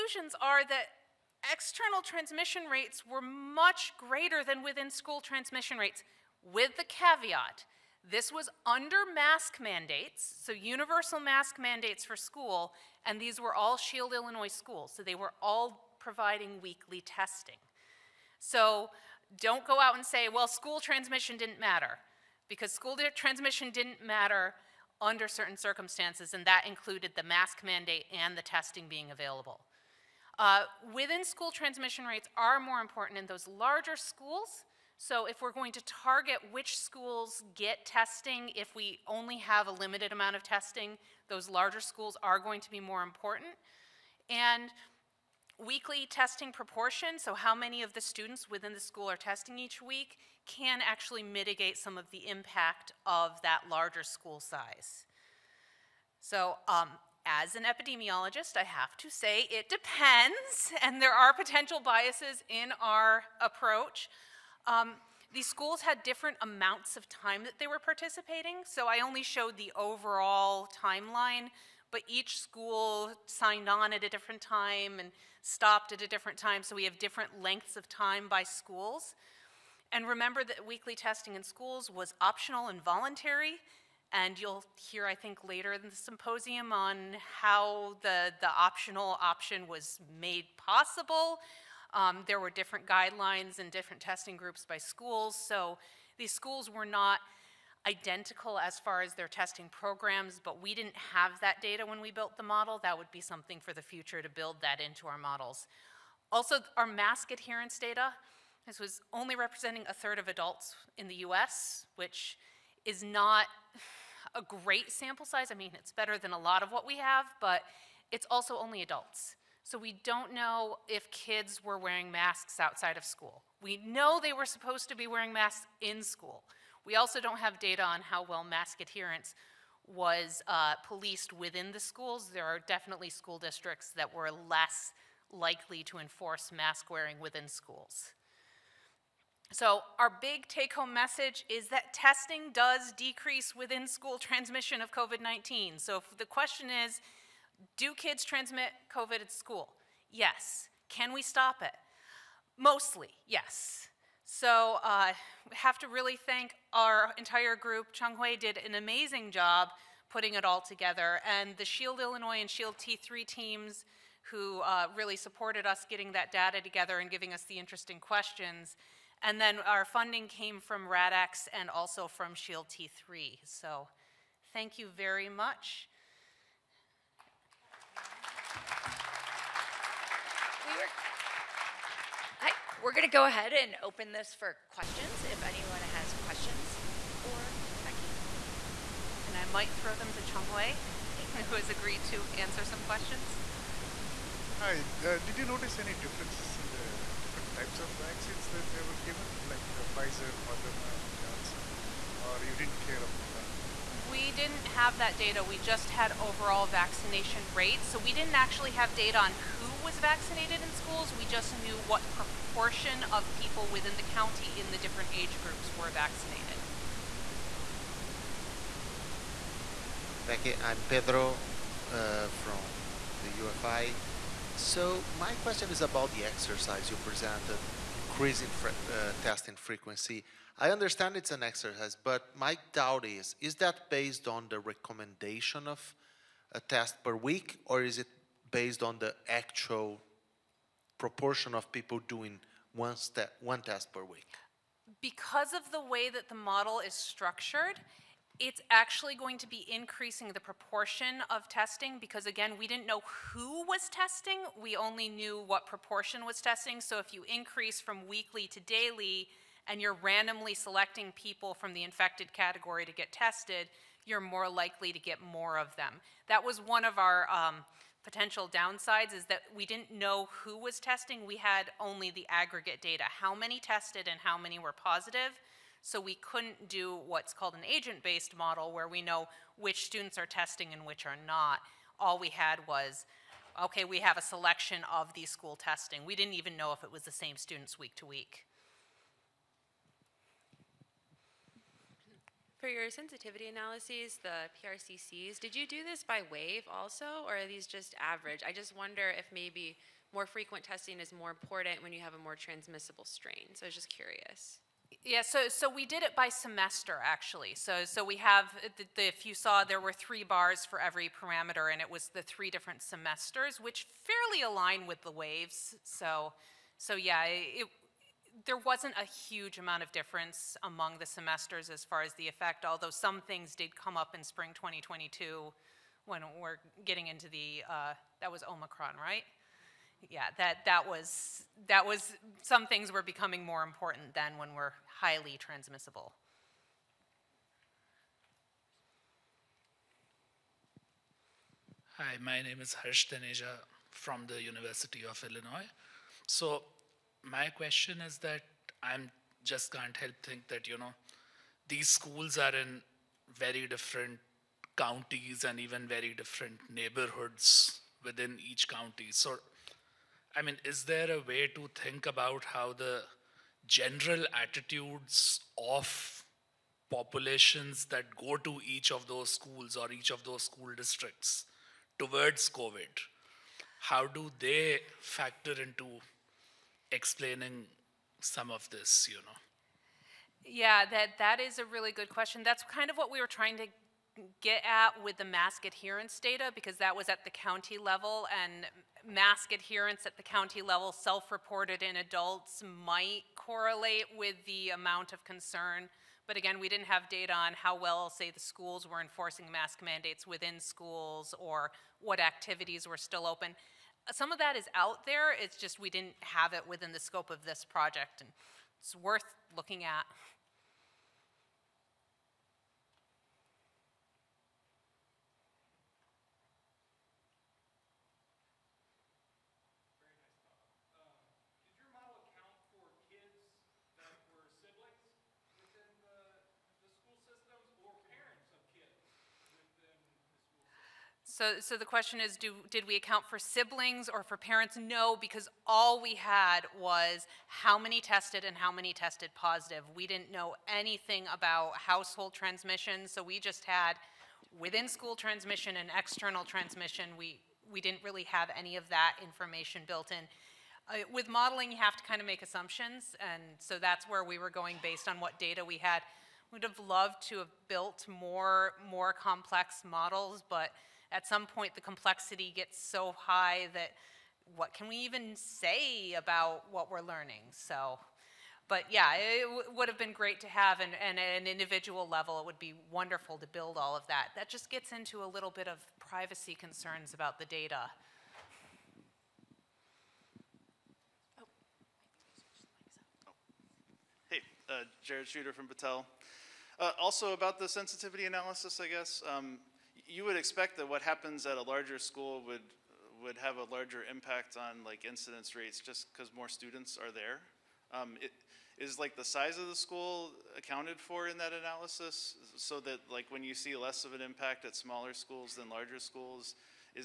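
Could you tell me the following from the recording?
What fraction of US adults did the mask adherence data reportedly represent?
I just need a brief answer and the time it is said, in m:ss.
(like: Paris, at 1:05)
a third, at 1:49.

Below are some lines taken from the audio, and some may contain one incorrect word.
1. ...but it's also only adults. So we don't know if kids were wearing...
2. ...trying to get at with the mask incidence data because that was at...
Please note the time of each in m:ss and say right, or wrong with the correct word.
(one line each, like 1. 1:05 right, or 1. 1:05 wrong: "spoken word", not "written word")
1. 1:57 right
2. 6:23 wrong: "adherence", not "incidence".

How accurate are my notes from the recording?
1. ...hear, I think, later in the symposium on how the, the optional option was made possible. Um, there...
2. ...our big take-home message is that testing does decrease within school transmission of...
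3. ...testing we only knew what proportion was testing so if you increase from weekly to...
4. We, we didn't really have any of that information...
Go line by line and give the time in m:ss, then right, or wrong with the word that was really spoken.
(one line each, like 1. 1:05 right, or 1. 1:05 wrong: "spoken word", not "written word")
1. 1:24 right
2. 2:19 right
3. 4:13 right
4. 7:27 right.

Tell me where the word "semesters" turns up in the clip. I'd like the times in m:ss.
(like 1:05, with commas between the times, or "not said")
5:06, 5:12, 5:21.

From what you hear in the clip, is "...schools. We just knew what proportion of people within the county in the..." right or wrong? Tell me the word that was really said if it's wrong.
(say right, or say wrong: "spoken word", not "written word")
right.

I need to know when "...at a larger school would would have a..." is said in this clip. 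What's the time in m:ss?
8:11.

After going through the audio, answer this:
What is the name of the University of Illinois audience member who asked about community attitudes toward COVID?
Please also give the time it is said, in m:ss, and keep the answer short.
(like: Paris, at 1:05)
Harsh Taneja, at 5:42.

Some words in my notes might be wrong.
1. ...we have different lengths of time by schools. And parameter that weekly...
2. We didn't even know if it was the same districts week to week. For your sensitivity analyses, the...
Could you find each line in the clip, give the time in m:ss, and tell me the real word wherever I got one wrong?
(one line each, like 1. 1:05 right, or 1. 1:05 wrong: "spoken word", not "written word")
1. 1:16 wrong: "remember", not "parameter"
2. 4:46 wrong: "students", not "districts".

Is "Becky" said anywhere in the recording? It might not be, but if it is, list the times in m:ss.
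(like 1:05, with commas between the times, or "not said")
3:07, 3:40.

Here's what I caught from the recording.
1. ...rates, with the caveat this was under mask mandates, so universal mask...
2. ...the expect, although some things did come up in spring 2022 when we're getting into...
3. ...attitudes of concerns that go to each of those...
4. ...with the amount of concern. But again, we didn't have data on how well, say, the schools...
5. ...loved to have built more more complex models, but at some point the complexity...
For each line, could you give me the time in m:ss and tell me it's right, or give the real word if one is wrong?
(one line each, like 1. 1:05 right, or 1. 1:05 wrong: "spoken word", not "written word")
1. 0:05 right
2. 5:22 wrong: "effect", not "expect"
3. 6:04 wrong: "populations", not "concerns"
4. 6:34 right
5. 7:36 right.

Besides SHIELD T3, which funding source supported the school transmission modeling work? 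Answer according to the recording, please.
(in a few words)
RADx.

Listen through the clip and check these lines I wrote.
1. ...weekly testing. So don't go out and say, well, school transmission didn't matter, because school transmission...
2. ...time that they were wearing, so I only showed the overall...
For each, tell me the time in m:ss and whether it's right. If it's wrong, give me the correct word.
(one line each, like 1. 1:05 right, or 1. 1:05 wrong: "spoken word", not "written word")
1. 0:16 right
2. 1:07 wrong: "participating", not "wearing".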